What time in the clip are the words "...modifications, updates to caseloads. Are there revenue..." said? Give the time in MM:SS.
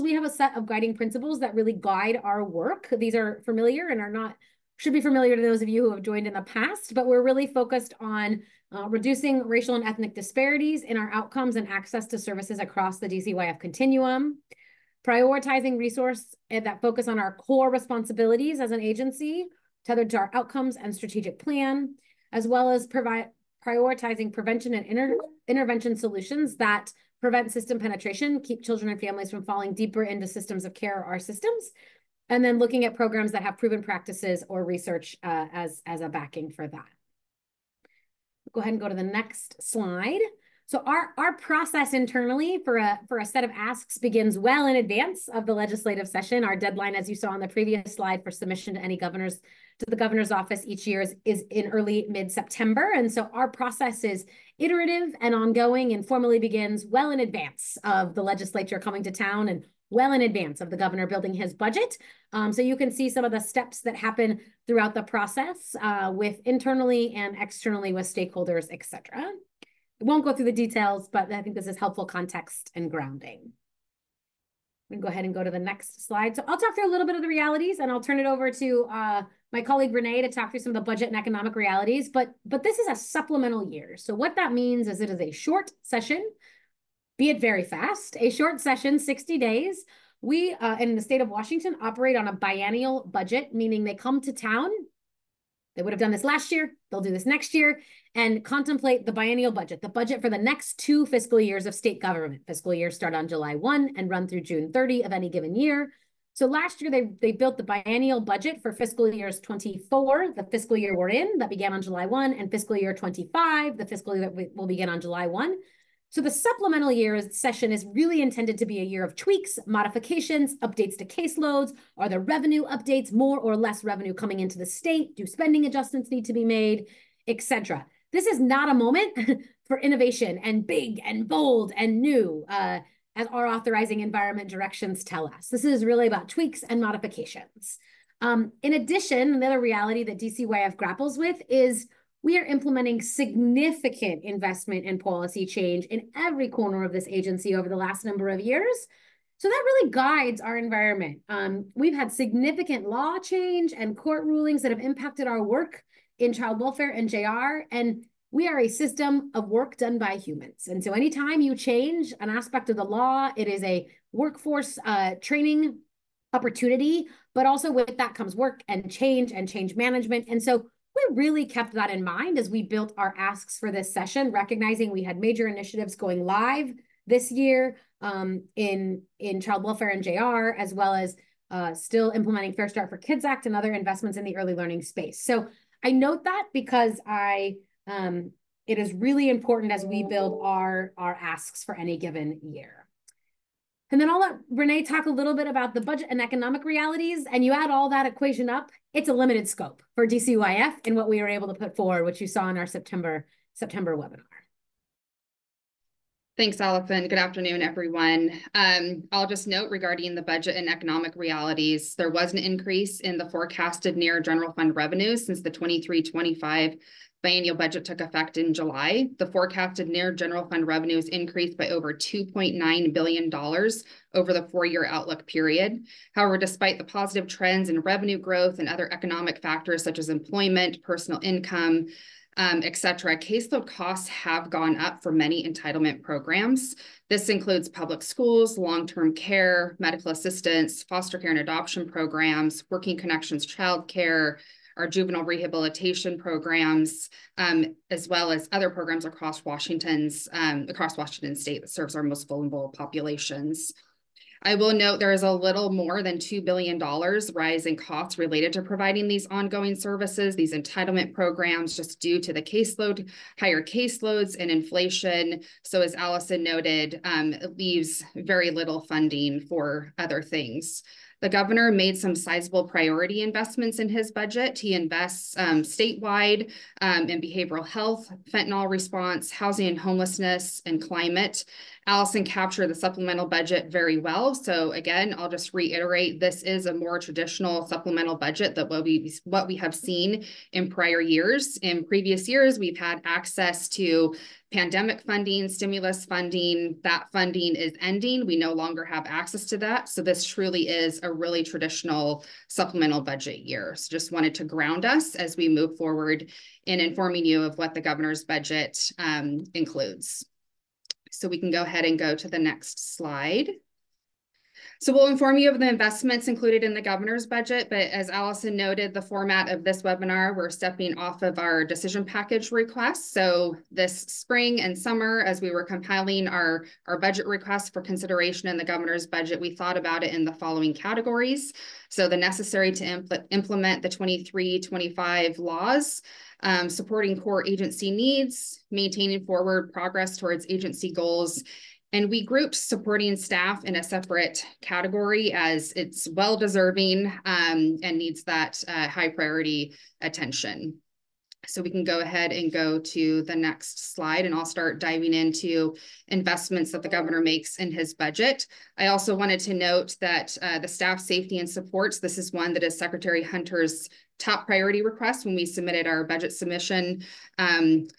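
01:59.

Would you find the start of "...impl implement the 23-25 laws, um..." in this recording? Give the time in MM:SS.
05:32.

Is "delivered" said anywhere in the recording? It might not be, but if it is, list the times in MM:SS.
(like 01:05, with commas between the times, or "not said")
not said.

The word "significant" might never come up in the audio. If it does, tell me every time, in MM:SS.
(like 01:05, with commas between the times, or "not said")
02:23, 02:32.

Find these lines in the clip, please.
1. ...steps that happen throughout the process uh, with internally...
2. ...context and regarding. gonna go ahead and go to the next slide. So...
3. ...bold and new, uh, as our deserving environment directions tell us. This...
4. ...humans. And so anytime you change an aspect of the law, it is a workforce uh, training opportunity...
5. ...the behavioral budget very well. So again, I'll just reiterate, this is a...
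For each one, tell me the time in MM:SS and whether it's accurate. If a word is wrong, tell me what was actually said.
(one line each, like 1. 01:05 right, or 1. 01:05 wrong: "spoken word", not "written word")
1. 01:03 right
2. 01:12 wrong: "grounding", not "regarding"
3. 02:11 wrong: "authorizing", not "deserving"
4. 02:40 right
5. 04:42 wrong: "supplemental", not "behavioral".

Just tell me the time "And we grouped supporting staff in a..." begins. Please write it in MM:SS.
05:41.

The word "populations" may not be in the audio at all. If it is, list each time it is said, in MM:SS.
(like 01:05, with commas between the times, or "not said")
04:12.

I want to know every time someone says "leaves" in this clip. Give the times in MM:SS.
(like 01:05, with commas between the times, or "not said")
04:27.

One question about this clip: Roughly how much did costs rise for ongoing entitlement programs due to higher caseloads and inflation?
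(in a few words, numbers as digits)
$2 billion.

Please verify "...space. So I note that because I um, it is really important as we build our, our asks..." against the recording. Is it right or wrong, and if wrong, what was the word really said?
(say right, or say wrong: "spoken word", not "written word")
right.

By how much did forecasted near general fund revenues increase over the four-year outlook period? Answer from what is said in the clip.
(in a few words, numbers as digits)
$2.9 billion.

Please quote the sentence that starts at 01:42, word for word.
Fiscal years start on July 1 and run through June 30 of any given year.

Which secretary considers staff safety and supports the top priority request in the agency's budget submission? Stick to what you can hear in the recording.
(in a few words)
Secretary Hunter.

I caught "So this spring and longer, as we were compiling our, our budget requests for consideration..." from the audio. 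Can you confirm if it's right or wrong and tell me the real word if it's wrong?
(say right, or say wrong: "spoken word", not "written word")
wrong: "summer", not "longer".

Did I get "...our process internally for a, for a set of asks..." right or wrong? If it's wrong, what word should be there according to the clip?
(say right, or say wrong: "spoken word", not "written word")
right.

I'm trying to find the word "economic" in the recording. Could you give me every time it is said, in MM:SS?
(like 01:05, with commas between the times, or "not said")
01:21, 03:16, 03:30, 03:48.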